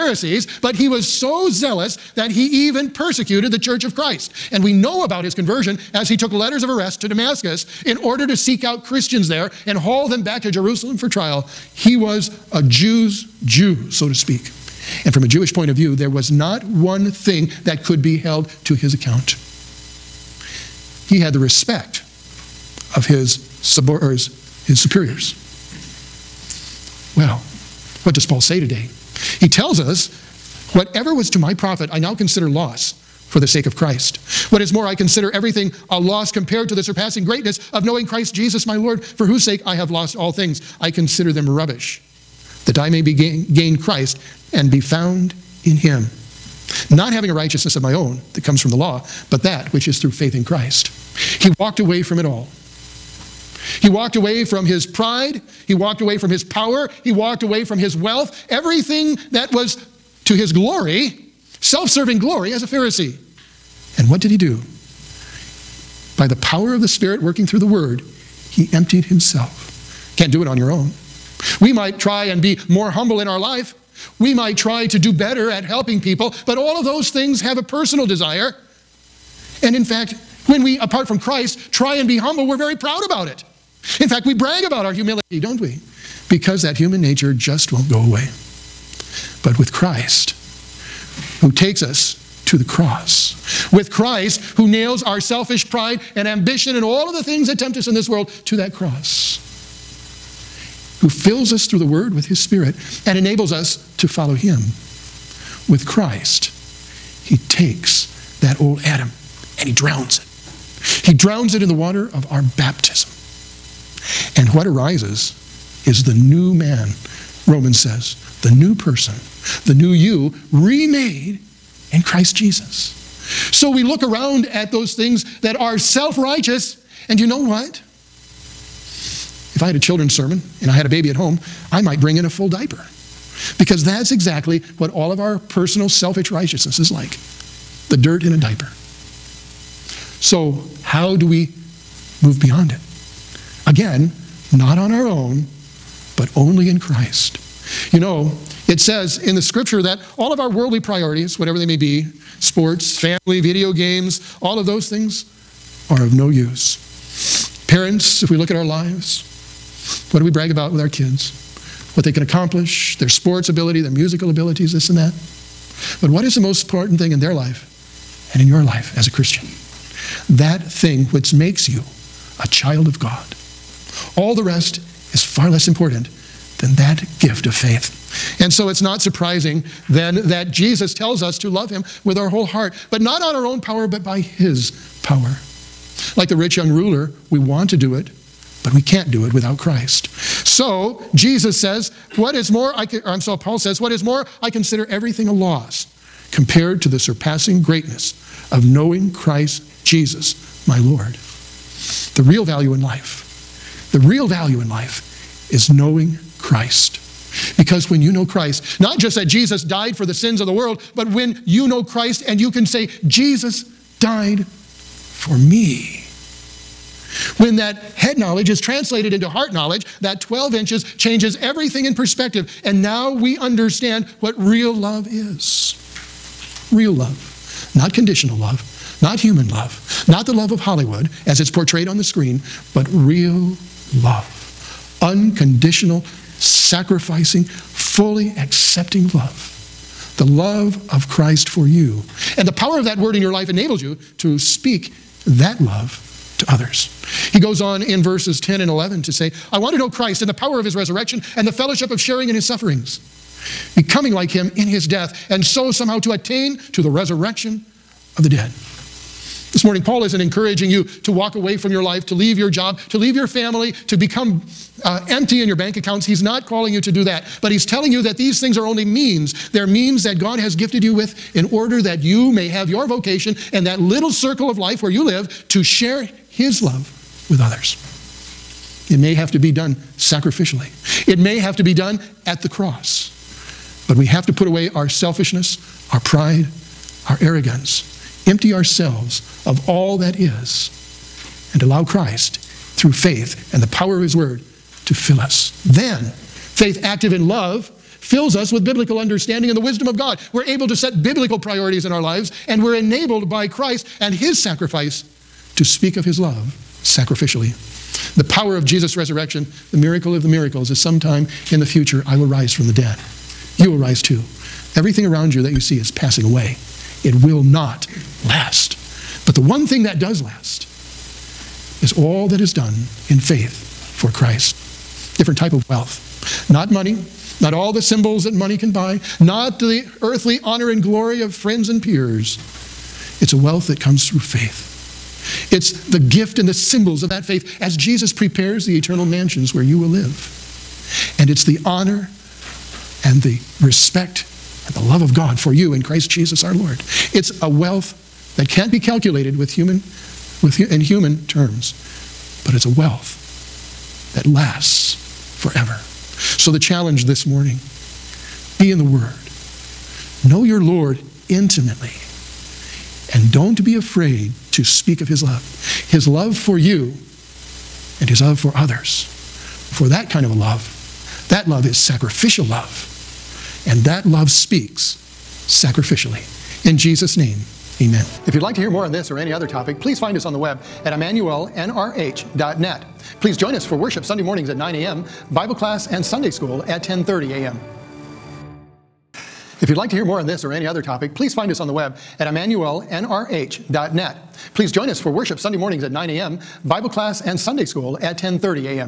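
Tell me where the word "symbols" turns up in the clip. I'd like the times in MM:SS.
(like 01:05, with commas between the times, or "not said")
05:27, 05:36.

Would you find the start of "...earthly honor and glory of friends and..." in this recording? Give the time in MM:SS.
05:30.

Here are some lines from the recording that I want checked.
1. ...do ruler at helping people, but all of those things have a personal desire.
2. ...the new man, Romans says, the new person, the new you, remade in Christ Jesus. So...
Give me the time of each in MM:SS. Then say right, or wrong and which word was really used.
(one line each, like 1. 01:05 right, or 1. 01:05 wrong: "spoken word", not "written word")
1. 01:14 wrong: "better", not "ruler"
2. 01:56 right.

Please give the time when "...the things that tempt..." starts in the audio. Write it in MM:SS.
01:37.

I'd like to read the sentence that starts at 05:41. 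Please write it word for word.
And it's the honor and the respect and the love of God for you in Christ Jesus our Lord.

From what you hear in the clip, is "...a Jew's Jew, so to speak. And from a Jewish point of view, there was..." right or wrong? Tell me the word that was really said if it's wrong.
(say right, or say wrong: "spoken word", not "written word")
right.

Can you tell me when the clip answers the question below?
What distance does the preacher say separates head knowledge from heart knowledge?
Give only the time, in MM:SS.
03:40.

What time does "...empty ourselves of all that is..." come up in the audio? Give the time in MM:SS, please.
04:48.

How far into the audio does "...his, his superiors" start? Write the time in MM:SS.
00:24.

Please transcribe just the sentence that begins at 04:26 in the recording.
He's not calling you to do that, but He's telling you that these things are only means.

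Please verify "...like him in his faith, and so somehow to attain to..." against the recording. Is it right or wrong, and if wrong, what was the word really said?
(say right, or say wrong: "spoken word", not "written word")
wrong: "death", not "faith".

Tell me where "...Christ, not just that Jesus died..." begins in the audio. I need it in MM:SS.
03:28.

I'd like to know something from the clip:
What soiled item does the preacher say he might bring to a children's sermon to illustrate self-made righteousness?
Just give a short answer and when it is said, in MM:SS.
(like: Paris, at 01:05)
A full diaper, at 02:12.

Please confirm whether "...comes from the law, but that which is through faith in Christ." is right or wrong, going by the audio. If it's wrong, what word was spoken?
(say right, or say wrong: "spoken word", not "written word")
right.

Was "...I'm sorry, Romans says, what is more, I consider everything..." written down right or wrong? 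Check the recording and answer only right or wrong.
wrong.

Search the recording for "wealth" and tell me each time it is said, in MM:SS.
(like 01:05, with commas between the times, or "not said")
00:57, 05:25, 05:33, 05:47, 05:52.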